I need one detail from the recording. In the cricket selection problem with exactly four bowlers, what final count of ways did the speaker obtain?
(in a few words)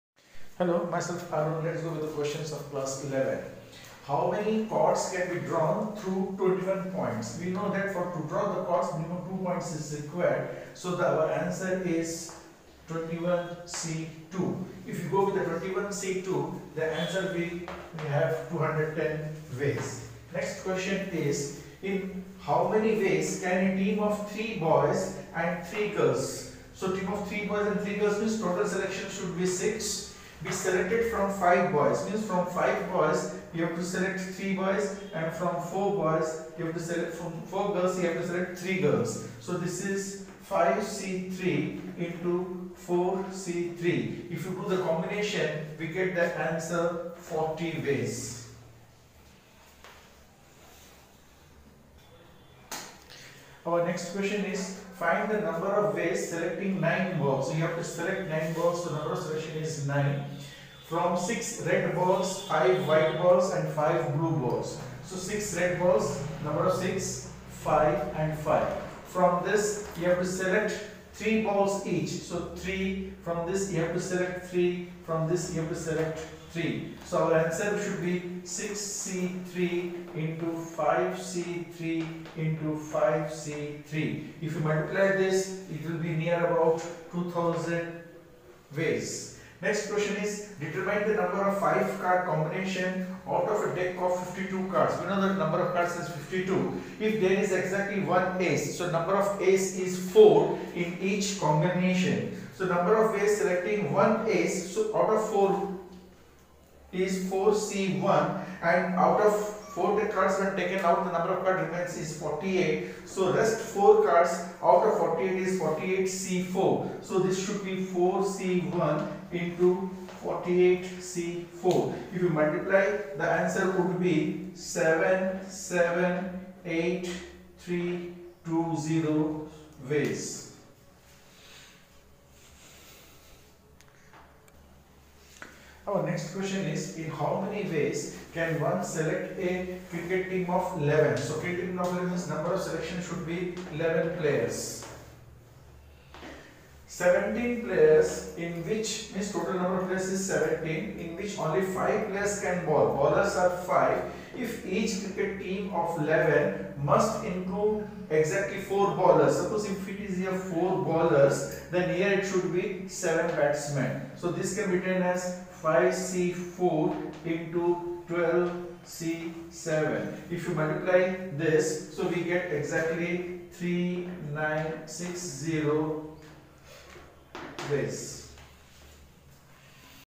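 3960.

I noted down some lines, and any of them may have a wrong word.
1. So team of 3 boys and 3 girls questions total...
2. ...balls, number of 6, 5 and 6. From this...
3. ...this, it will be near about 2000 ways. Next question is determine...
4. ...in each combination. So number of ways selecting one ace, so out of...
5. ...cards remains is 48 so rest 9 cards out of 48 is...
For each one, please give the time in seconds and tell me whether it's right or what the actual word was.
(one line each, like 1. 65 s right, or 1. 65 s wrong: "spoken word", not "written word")
1. 26 s wrong: "means", not "questions"
2. 65 s wrong: "5", not "6"
3. 85 s right
4. 100 s right
5. 111 s wrong: "4", not "9".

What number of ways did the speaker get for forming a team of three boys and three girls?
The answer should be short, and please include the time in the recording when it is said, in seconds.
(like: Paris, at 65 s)
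40, at 47 s.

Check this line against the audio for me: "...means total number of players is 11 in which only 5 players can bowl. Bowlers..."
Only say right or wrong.
wrong.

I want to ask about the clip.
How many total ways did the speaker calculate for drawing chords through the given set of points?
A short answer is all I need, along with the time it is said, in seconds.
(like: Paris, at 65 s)
210, at 18 s.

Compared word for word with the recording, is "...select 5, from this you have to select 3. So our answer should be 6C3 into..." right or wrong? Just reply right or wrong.
wrong.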